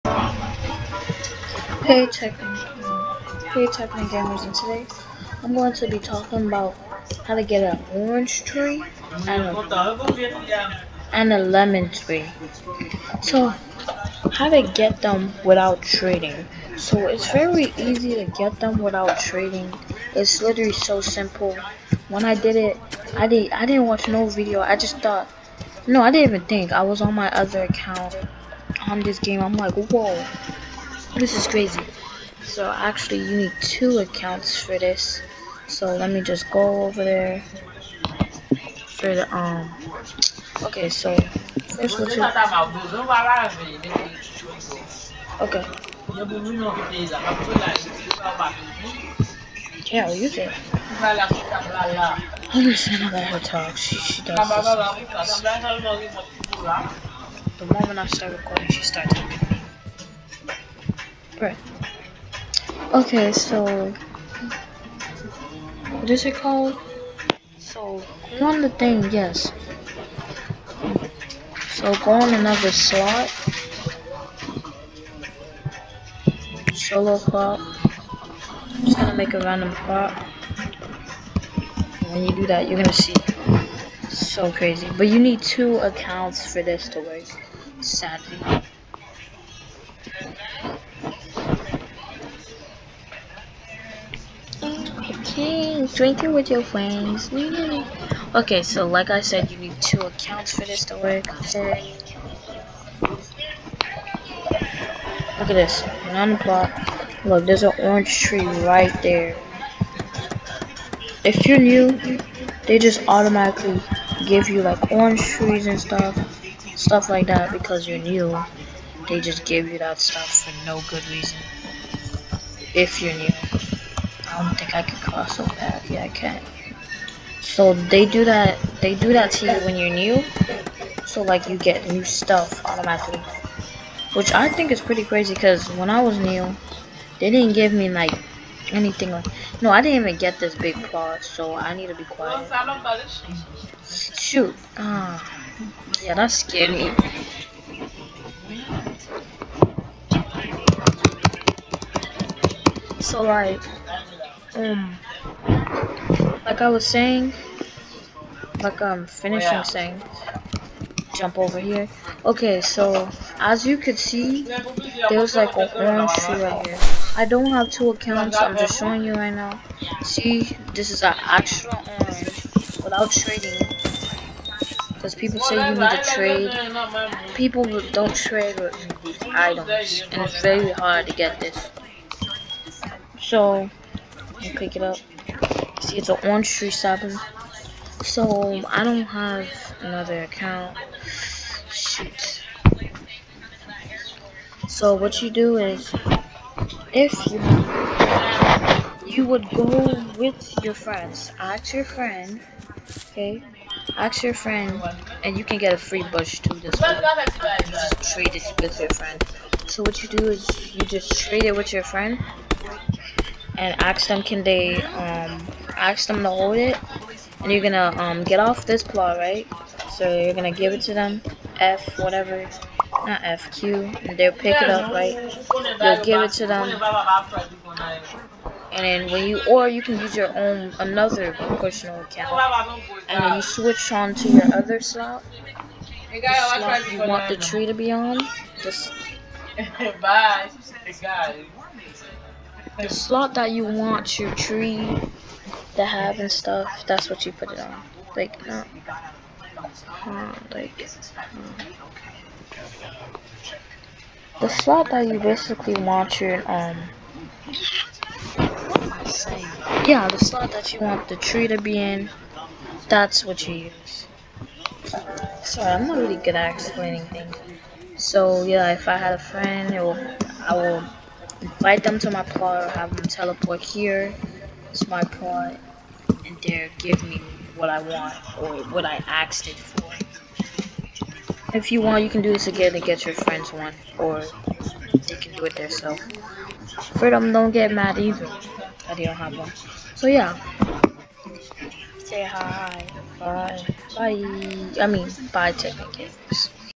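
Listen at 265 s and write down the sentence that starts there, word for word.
Sorry, I'm not really good at explaining things.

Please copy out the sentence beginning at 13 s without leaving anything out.
So how to get them without trading.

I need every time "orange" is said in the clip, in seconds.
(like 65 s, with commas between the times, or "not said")
7 s, 107 s, 114 s, 165 s, 171 s, 186 s.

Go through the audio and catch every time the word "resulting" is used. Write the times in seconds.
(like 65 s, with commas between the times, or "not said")
not said.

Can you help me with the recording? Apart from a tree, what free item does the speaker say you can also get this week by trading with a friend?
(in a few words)
bush.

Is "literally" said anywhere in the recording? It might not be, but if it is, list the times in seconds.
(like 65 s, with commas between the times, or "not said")
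20 s.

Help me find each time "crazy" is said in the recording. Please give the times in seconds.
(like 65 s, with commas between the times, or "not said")
31 s, 84 s, 135 s.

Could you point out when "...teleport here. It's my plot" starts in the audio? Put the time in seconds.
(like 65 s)
273 s.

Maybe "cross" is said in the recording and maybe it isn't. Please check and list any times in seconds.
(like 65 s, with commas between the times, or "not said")
124 s.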